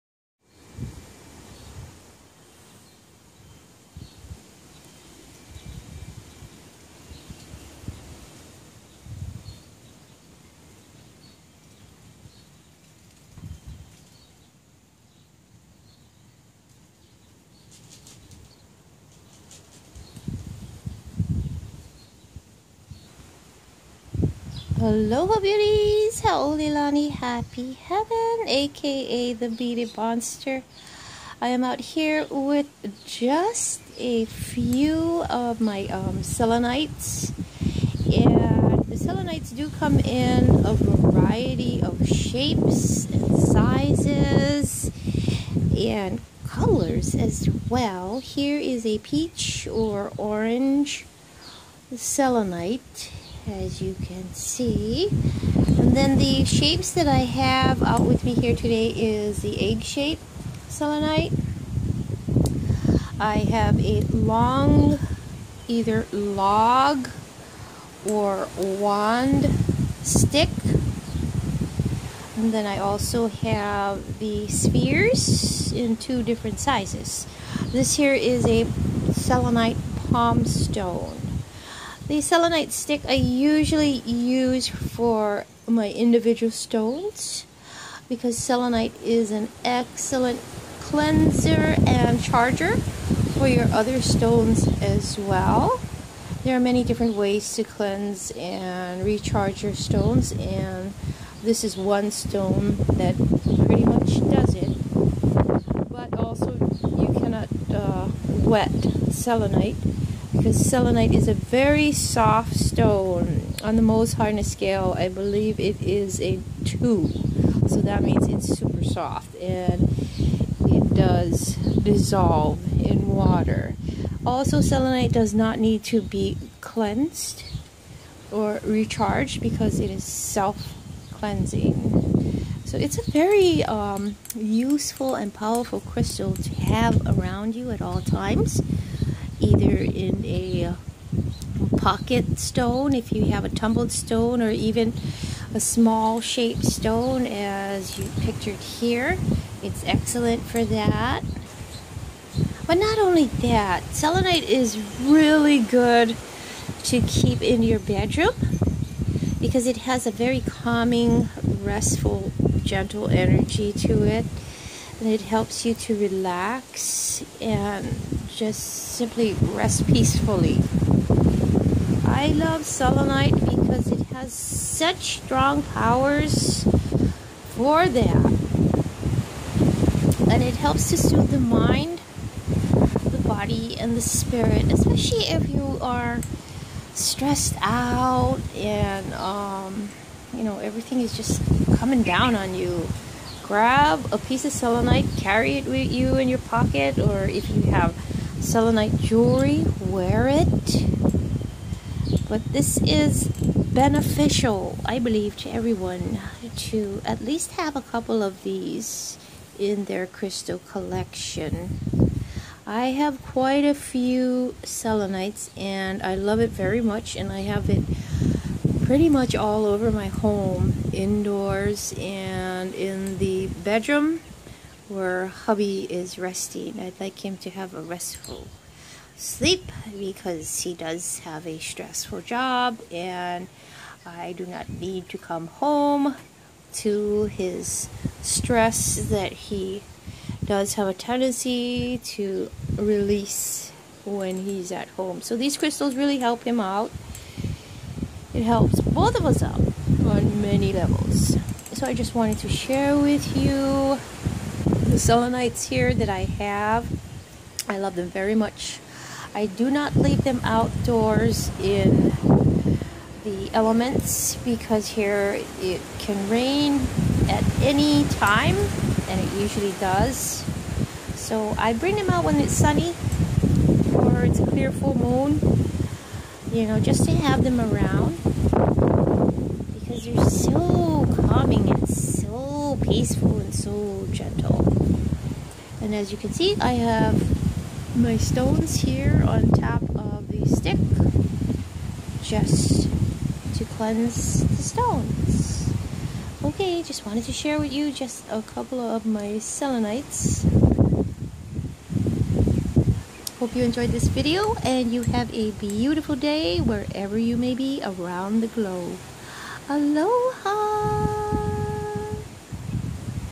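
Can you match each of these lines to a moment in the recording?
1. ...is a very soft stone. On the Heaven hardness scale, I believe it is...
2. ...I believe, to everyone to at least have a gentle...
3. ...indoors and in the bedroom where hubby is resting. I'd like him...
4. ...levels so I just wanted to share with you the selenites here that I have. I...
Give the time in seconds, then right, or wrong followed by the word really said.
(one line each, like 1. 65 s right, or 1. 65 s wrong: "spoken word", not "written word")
1. 111 s wrong: "Mohs", not "Heaven"
2. 204 s wrong: "couple", not "gentle"
3. 220 s right
4. 250 s right.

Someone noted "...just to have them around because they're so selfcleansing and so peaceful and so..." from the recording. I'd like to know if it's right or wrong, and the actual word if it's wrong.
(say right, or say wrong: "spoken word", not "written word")
wrong: "calming", not "selfcleansing".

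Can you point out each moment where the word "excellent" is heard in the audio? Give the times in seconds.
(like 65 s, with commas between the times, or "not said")
89 s, 149 s.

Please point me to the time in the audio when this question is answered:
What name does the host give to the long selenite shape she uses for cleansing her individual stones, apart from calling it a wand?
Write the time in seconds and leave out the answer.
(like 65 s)
66 s.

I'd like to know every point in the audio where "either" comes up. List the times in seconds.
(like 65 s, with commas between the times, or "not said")
65 s, 139 s.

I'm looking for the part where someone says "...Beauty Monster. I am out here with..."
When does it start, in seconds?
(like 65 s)
29 s.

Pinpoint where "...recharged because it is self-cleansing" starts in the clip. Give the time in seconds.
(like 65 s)
128 s.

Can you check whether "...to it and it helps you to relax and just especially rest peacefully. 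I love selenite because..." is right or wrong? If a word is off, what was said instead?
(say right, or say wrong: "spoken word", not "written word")
wrong: "simply", not "especially".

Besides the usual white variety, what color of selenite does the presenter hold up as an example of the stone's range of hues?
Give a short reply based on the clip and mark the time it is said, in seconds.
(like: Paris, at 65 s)
Peach or orange, at 48 s.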